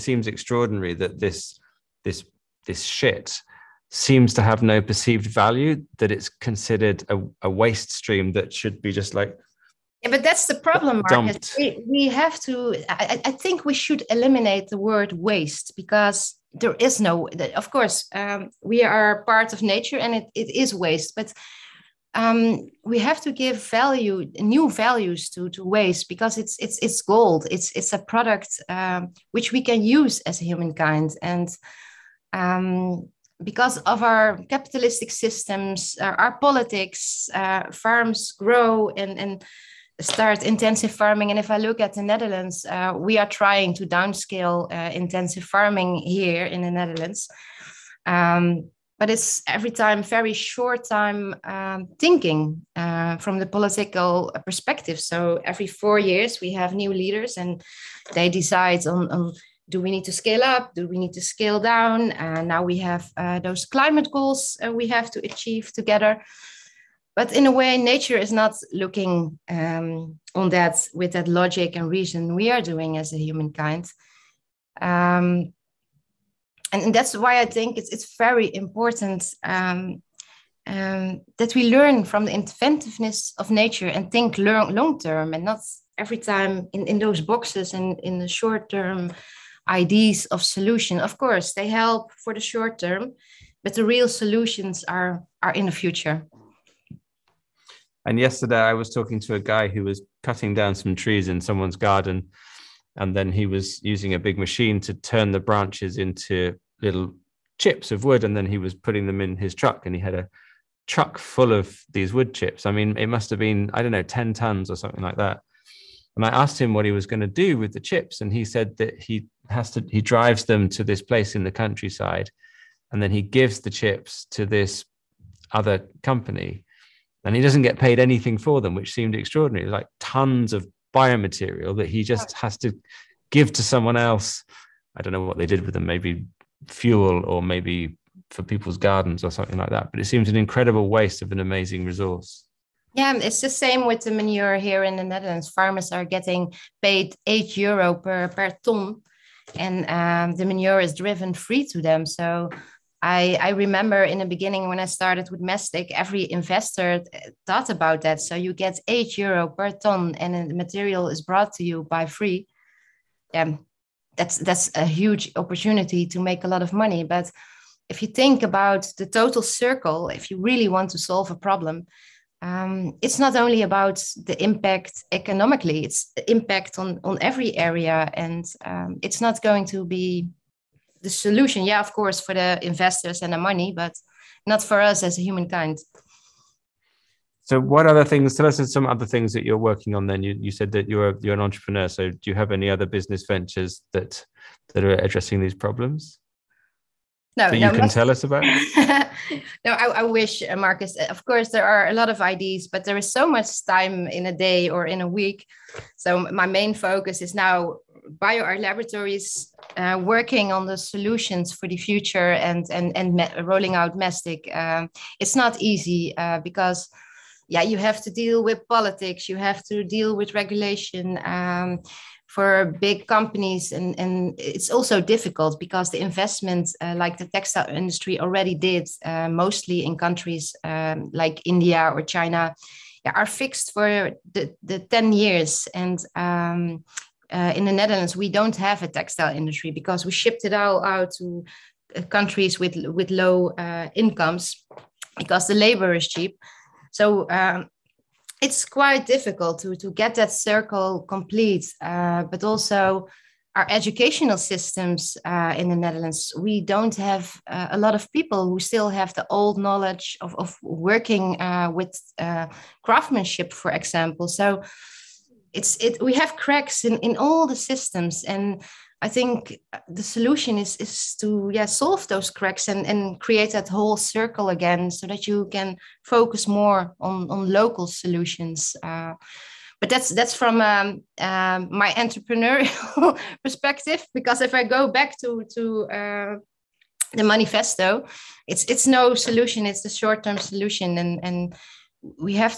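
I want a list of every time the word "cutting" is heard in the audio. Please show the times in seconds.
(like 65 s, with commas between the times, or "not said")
100 s.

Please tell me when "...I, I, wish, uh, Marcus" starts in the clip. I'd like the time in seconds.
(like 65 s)
199 s.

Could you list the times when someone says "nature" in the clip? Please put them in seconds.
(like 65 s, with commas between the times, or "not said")
19 s, 67 s, 83 s.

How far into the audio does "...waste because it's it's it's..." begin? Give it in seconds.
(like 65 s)
25 s.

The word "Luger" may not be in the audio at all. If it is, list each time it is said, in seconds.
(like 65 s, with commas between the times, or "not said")
not said.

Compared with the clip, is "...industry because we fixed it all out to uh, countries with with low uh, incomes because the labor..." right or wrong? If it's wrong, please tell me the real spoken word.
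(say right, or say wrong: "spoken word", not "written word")
wrong: "shipped", not "fixed".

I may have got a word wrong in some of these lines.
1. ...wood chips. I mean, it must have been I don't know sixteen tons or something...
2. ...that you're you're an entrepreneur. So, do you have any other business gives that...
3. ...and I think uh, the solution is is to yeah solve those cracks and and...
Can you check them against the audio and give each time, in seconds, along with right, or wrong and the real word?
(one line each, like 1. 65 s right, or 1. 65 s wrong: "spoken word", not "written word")
1. 112 s wrong: "ten", not "sixteen"
2. 190 s wrong: "ventures", not "gives"
3. 268 s right.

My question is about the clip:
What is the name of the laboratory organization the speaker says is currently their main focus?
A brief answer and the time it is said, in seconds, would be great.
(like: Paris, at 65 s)
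BioArt Laboratories, at 208 s.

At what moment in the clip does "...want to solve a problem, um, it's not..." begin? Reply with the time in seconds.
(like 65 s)
170 s.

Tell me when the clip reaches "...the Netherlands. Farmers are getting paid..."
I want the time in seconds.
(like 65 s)
144 s.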